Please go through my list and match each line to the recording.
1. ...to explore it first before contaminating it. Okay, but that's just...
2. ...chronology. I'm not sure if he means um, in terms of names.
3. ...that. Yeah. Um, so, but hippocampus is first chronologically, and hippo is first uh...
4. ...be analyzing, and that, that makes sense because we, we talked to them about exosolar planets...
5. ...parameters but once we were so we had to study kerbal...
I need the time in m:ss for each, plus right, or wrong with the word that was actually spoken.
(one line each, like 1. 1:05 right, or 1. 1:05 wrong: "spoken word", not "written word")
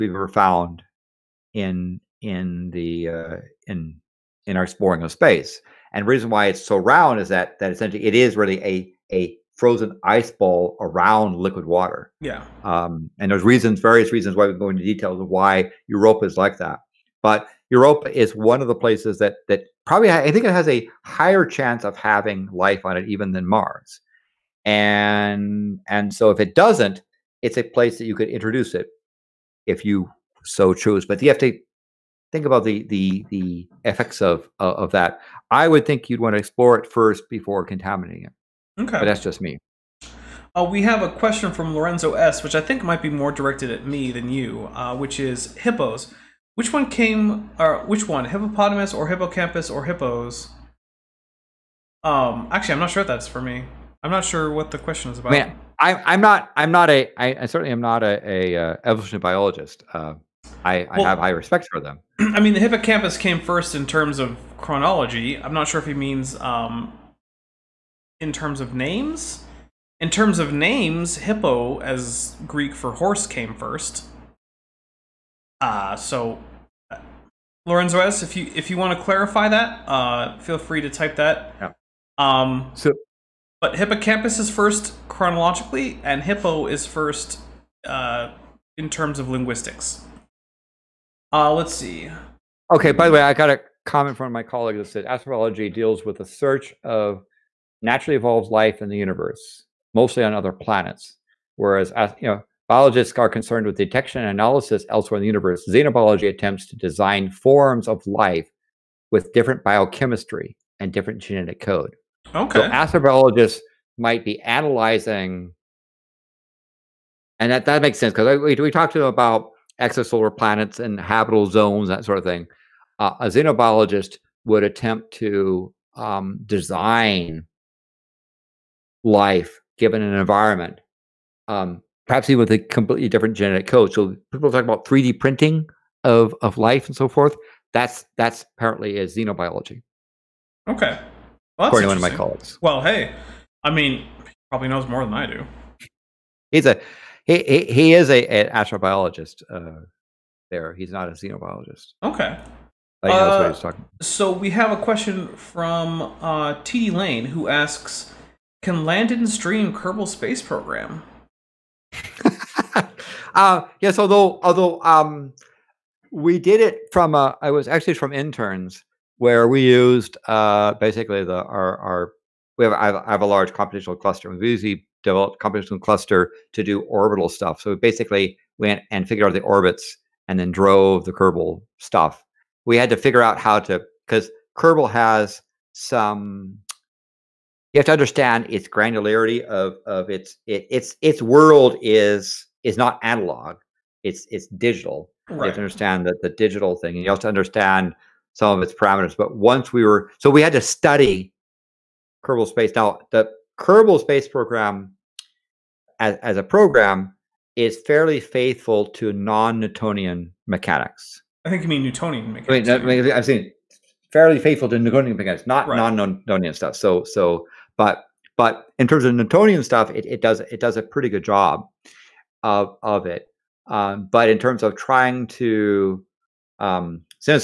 1. 0:36 right
2. 1:04 right
3. 1:21 right
4. 1:54 right
5. 3:18 right.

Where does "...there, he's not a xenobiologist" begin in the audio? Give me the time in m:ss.
2:30.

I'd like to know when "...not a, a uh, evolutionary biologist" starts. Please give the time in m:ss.
0:57.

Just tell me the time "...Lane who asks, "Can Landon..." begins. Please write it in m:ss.
2:36.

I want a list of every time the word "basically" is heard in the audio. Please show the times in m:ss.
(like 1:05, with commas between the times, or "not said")
2:50, 2:57.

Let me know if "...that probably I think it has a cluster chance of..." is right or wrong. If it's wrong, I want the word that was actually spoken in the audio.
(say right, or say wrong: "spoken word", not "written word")
wrong: "higher", not "cluster".